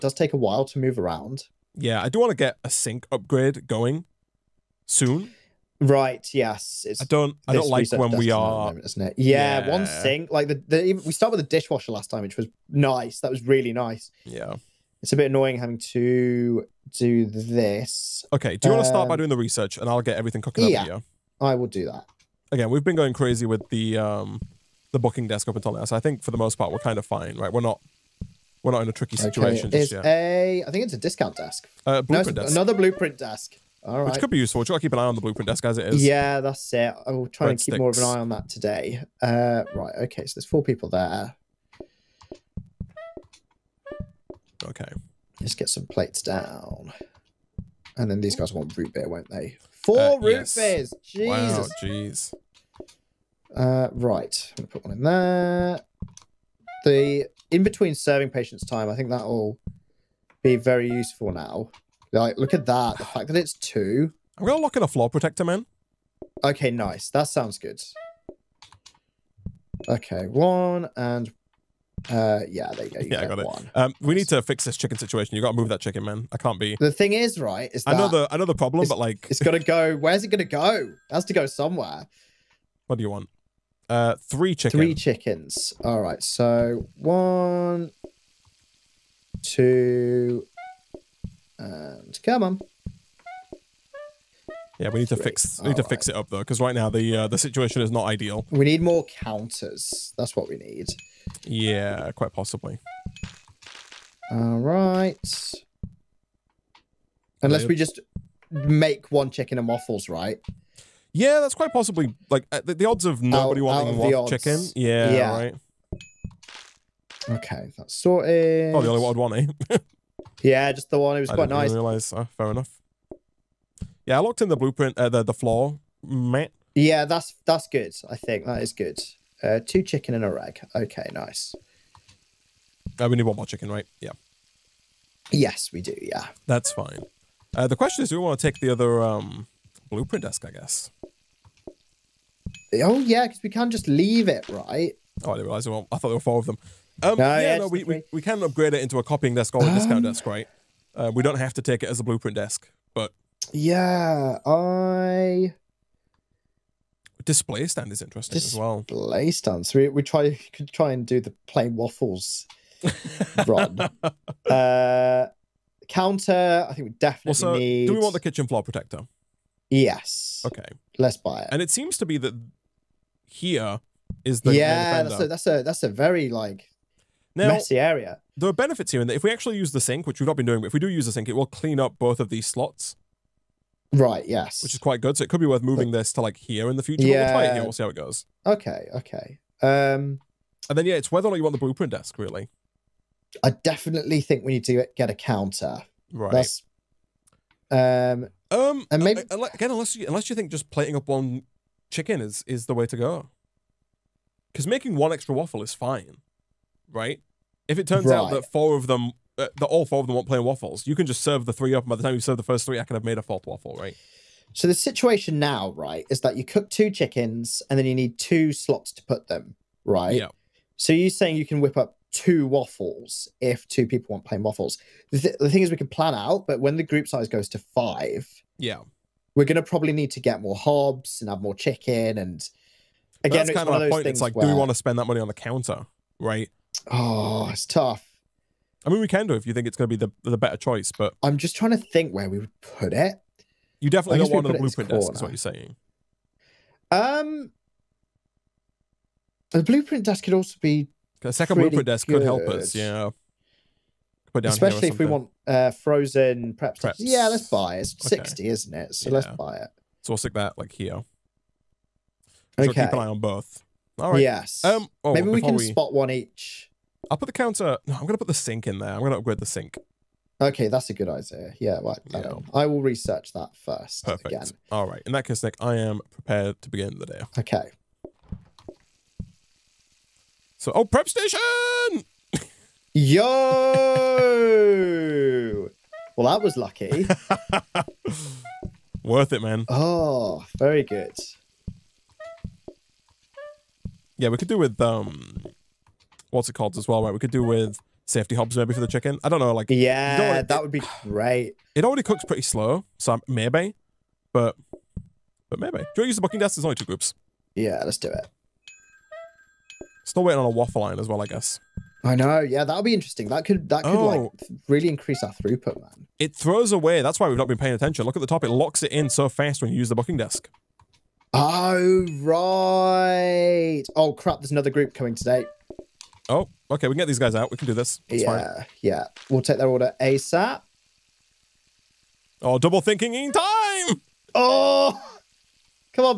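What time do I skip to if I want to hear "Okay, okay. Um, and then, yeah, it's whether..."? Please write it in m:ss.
3:08.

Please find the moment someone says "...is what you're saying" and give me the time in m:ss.
4:05.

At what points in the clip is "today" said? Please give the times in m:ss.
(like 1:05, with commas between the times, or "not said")
0:38, 5:25.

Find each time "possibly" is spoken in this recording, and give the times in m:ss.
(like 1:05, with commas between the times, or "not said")
1:42, 1:51.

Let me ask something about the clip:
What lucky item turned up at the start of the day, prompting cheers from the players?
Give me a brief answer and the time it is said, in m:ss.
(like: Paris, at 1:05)
prep station, at 4:40.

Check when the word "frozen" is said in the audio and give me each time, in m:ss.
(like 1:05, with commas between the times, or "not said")
4:15.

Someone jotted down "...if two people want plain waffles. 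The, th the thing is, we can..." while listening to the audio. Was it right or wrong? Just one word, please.
right.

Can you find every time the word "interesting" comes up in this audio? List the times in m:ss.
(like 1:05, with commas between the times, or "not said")
2:38, 5:12.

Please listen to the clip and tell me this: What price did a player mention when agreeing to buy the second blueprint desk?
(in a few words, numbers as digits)
60.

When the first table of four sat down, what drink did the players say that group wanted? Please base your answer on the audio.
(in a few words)
root beer.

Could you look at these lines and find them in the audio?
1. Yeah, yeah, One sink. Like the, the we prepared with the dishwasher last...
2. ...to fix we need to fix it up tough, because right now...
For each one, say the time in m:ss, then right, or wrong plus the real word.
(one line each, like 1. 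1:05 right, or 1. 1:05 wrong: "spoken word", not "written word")
1. 0:09 wrong: "started", not "prepared"
2. 1:35 wrong: "though", not "tough".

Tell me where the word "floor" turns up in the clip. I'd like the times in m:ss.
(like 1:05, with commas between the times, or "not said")
1:04, 2:05, 2:48.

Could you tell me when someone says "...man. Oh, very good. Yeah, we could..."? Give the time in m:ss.
4:49.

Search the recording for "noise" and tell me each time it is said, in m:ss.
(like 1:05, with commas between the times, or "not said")
not said.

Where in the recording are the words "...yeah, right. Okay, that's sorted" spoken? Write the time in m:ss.
1:55.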